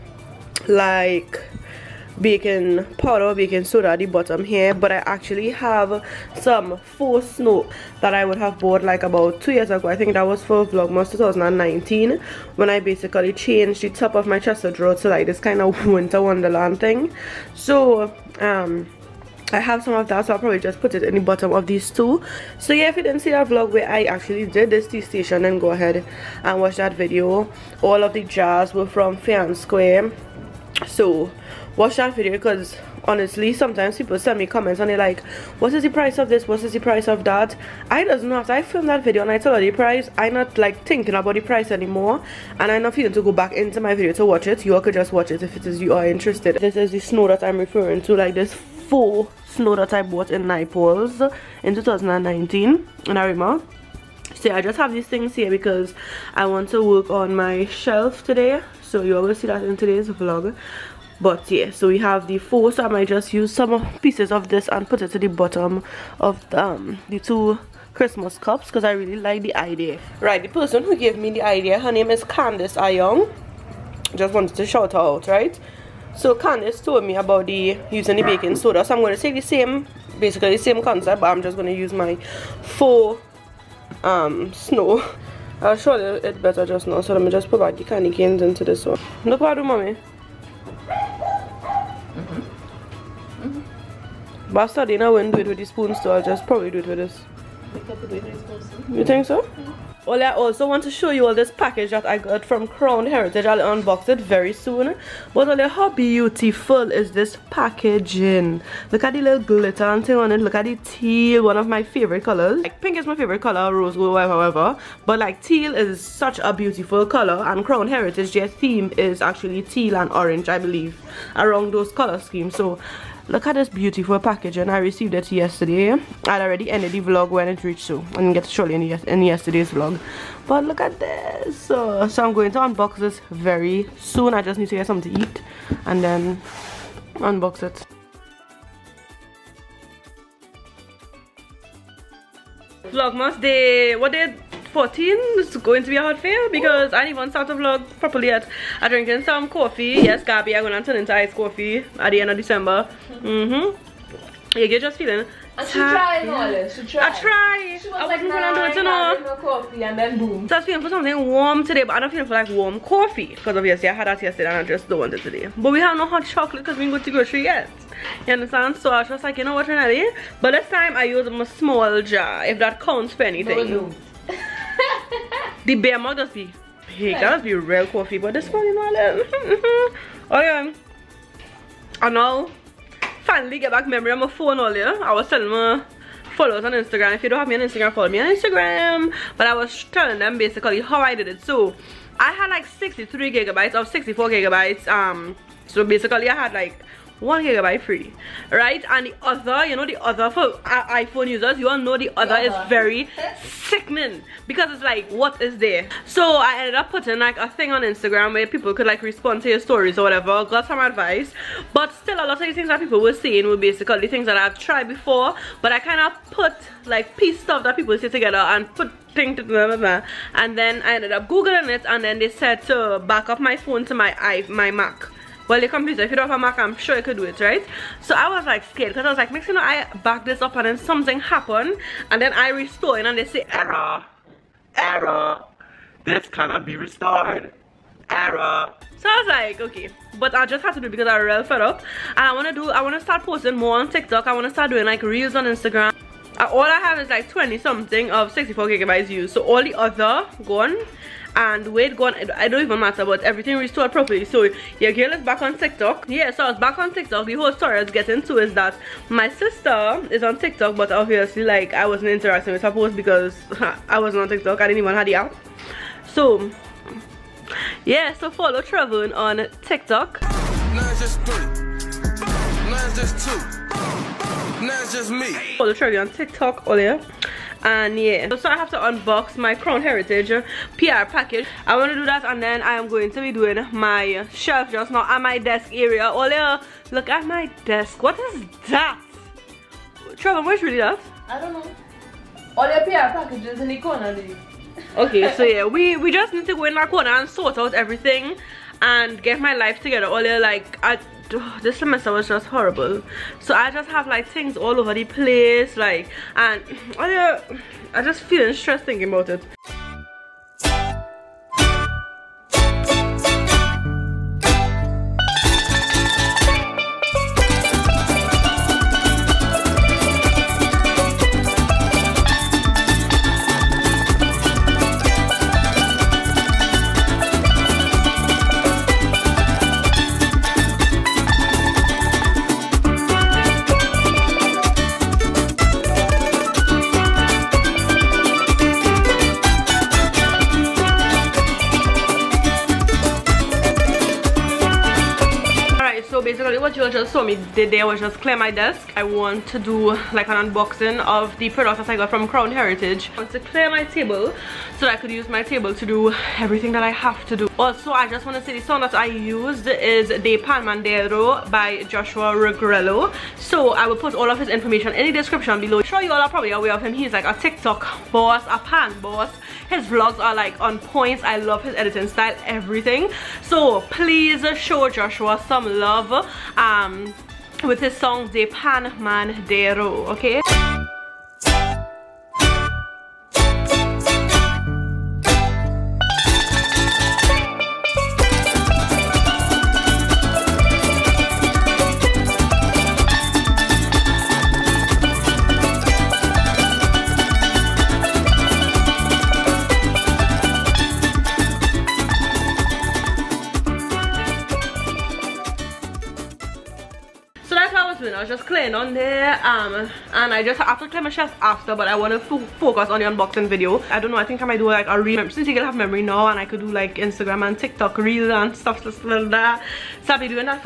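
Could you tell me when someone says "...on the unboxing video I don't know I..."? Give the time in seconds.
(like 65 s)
412 s.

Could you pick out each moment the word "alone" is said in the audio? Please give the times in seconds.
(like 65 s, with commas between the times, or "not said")
not said.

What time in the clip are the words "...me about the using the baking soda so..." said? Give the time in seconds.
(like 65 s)
77 s.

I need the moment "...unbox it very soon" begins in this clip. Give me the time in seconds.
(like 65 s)
103 s.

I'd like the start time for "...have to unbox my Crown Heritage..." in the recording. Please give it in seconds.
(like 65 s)
278 s.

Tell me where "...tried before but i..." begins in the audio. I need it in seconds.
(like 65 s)
214 s.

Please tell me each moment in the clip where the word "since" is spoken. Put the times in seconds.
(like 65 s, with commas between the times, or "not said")
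415 s.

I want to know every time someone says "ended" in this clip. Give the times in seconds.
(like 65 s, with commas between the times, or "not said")
126 s, 206 s, 220 s.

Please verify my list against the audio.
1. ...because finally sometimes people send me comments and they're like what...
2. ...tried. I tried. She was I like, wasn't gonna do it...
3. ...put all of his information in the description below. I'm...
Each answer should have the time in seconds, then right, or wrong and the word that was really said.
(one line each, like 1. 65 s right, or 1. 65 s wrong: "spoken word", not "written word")
1. 32 s wrong: "honestly", not "finally"
2. 156 s right
3. 363 s right.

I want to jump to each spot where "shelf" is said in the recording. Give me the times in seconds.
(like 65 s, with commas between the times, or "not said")
57 s, 284 s.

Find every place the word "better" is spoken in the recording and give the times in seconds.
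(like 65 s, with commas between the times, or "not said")
86 s.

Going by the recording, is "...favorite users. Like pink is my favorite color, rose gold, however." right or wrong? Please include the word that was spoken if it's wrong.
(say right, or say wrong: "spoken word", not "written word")
wrong: "colors", not "users".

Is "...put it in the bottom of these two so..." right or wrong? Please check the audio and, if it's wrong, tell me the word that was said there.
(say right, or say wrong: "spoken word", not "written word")
right.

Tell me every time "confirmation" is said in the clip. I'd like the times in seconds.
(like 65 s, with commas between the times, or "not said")
not said.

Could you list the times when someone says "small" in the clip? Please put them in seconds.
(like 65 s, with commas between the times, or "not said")
171 s.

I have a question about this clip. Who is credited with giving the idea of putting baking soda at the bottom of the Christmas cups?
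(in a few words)
Candice Ayong.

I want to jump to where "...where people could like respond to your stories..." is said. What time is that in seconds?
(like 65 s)
208 s.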